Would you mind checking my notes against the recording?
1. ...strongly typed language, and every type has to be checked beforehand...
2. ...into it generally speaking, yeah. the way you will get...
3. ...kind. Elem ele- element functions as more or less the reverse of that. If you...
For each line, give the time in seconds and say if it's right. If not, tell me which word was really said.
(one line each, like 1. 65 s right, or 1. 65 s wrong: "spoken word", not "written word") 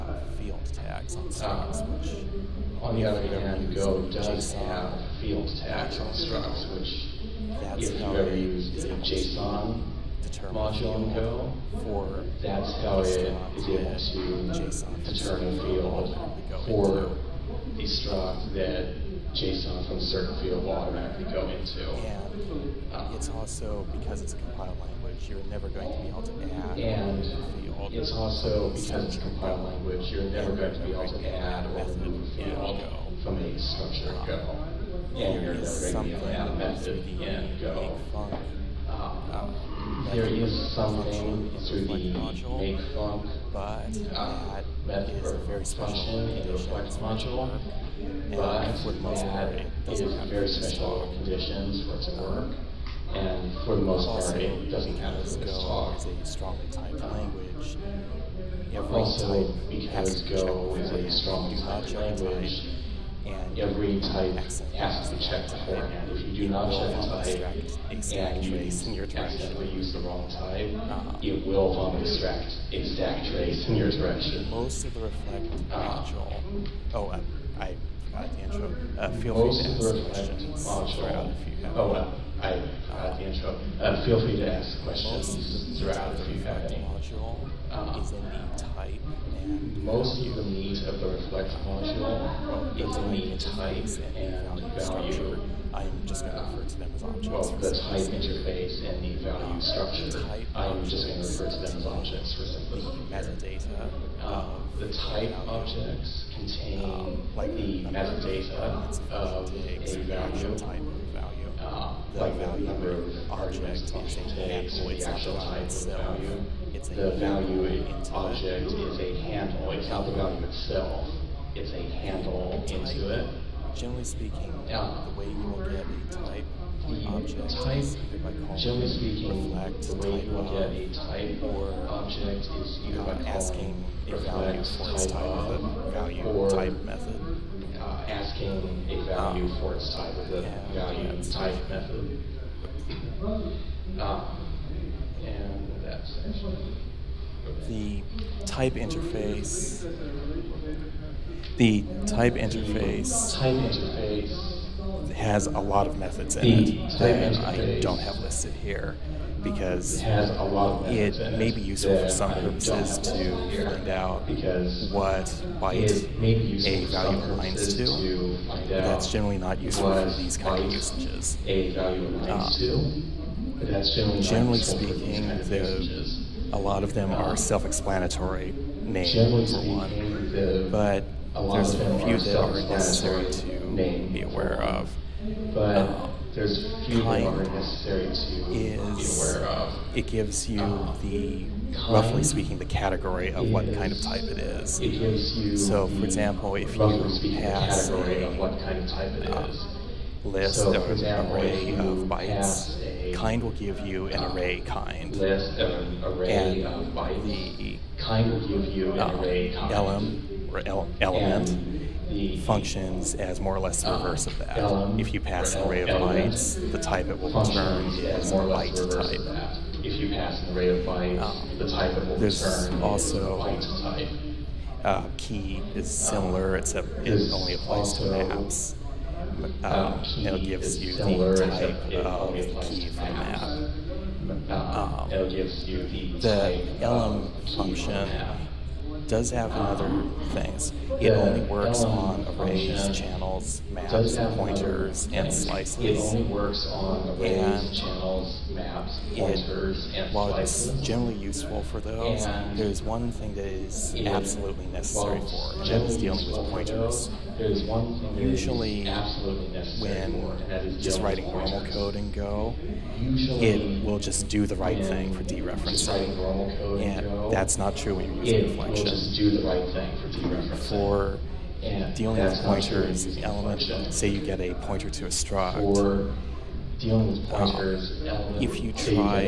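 1. 61 s right
2. 122 s right
3. 209 s right.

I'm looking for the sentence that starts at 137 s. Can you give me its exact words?
Uh, asking a value um, for its type of the yeah, value type method.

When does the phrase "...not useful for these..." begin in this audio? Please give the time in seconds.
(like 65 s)
169 s.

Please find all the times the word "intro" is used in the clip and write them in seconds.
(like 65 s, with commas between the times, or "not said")
78 s, 83 s.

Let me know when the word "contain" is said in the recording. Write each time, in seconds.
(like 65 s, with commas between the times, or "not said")
106 s.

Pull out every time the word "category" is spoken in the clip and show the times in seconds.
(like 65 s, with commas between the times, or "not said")
192 s, 197 s.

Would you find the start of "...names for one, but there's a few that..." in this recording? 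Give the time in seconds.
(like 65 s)
178 s.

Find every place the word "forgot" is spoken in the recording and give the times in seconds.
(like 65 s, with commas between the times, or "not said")
78 s, 82 s.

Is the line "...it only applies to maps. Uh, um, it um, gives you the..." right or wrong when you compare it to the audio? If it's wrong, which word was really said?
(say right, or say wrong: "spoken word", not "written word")
right.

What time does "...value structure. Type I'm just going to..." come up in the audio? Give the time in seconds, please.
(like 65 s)
99 s.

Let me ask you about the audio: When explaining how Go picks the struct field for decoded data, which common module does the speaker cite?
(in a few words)
JSON module.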